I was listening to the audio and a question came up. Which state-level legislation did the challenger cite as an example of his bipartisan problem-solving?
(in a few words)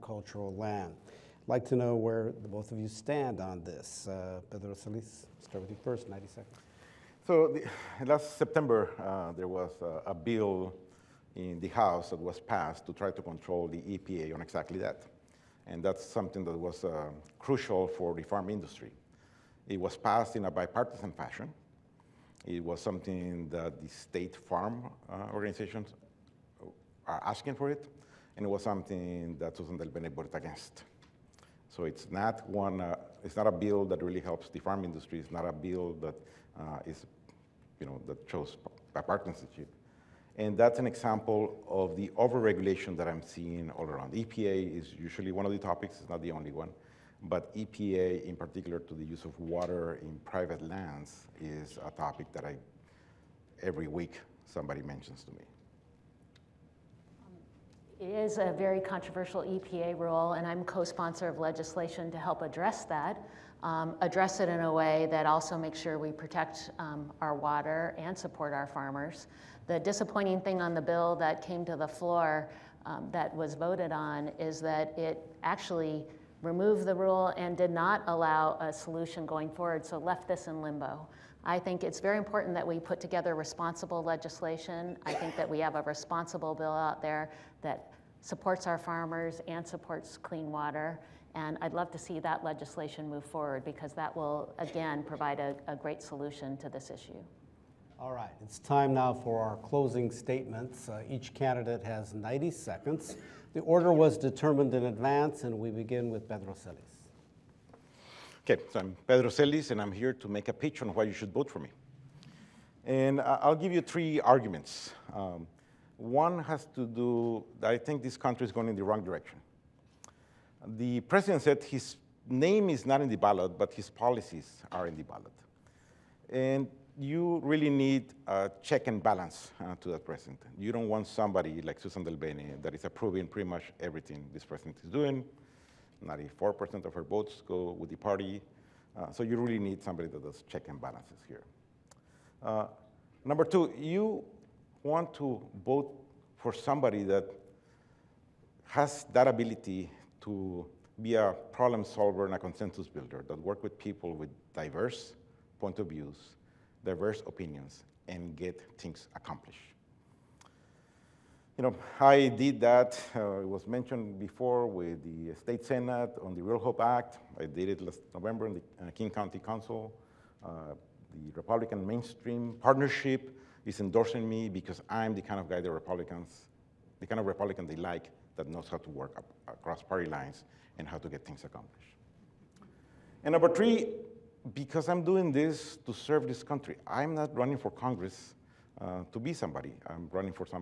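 Real Hope Act.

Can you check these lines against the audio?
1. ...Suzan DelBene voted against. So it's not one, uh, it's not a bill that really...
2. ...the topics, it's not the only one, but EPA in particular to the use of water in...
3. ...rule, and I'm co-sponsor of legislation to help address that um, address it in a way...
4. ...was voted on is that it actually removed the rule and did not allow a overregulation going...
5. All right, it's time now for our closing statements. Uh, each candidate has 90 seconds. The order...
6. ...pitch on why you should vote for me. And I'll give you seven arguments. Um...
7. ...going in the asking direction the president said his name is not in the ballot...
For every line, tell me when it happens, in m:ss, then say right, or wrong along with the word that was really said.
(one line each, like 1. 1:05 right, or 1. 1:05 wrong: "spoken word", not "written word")
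1. 0:29 right
2. 0:45 right
3. 0:59 right
4. 1:13 wrong: "solution", not "overregulation"
5. 1:37 right
6. 1:50 wrong: "three", not "seven"
7. 1:58 wrong: "wrong", not "asking".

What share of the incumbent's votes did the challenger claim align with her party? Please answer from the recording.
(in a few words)
94%.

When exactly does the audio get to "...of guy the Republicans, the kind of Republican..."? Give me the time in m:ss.
2:55.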